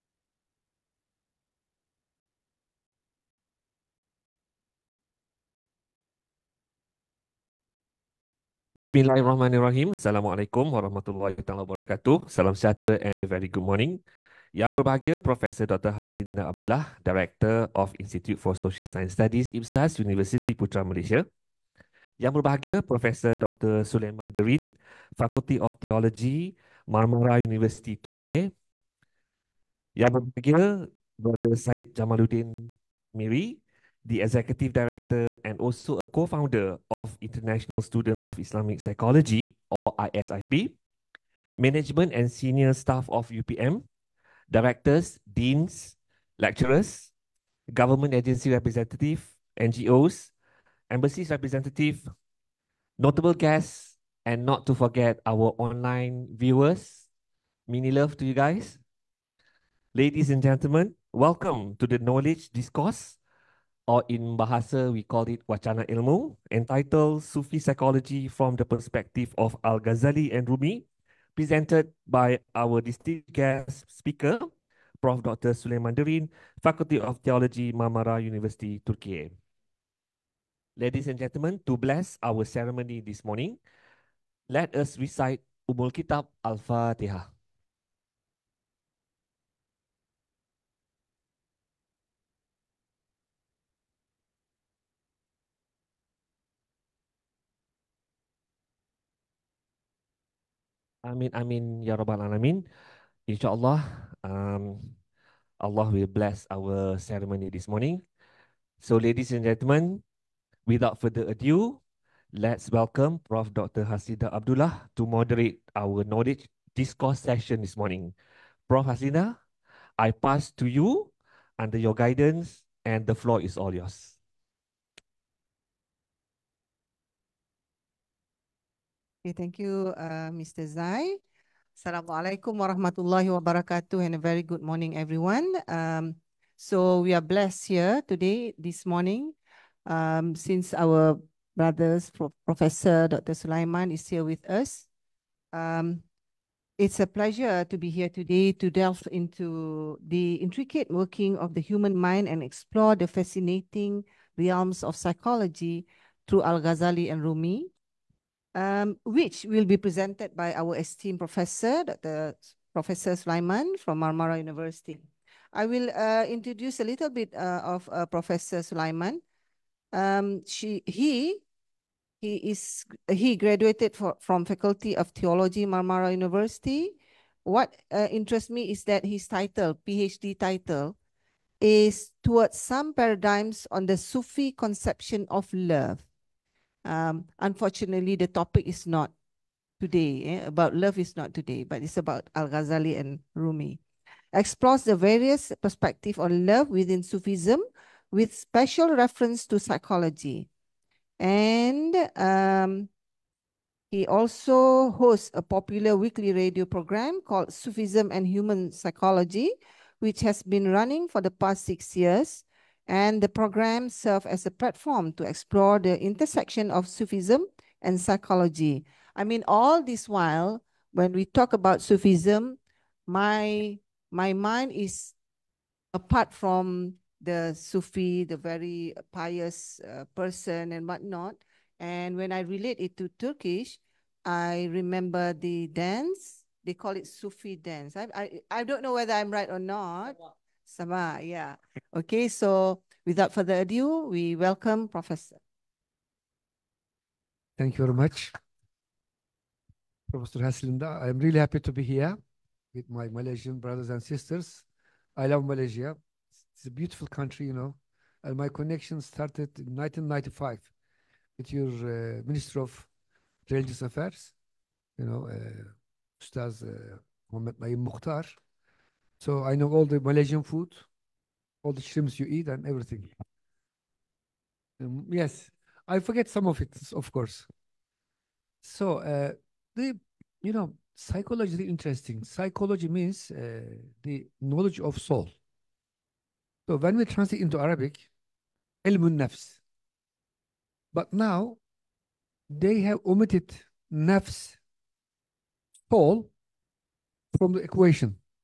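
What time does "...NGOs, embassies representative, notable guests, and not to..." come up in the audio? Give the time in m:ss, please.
0:49.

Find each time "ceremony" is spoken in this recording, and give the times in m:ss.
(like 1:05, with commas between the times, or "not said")
1:22, 1:46.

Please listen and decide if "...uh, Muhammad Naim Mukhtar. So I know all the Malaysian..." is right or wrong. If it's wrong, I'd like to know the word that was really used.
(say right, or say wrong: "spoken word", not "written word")
right.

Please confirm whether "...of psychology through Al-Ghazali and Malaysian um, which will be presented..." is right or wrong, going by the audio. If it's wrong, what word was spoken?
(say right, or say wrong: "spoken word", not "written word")
wrong: "Rumi", not "Malaysian".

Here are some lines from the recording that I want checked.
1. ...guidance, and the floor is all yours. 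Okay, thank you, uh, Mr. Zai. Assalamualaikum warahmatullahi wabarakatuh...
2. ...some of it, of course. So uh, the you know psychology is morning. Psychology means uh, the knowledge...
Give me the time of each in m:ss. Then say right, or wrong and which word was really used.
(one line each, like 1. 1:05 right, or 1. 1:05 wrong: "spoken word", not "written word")
1. 2:01 right
2. 4:36 wrong: "interesting", not "morning".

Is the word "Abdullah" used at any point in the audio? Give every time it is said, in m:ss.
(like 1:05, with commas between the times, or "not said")
0:16, 1:54.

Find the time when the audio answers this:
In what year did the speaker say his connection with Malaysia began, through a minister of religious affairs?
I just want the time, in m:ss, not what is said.
4:19.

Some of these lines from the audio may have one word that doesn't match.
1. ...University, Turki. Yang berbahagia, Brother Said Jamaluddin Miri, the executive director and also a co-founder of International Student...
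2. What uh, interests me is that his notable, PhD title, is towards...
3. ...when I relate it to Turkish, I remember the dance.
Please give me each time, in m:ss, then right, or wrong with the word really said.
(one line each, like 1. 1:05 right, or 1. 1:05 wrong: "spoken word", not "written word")
1. 0:27 right
2. 2:57 wrong: "title", not "notable"
3. 3:52 right.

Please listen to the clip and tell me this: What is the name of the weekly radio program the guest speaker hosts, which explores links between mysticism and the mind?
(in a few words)
Sufism and Human Psychology.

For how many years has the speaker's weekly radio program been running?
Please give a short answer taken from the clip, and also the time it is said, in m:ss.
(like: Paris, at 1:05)
6, at 3:31.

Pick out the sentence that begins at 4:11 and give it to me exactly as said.
I'm really happy to be here with my Malaysian brothers and sisters.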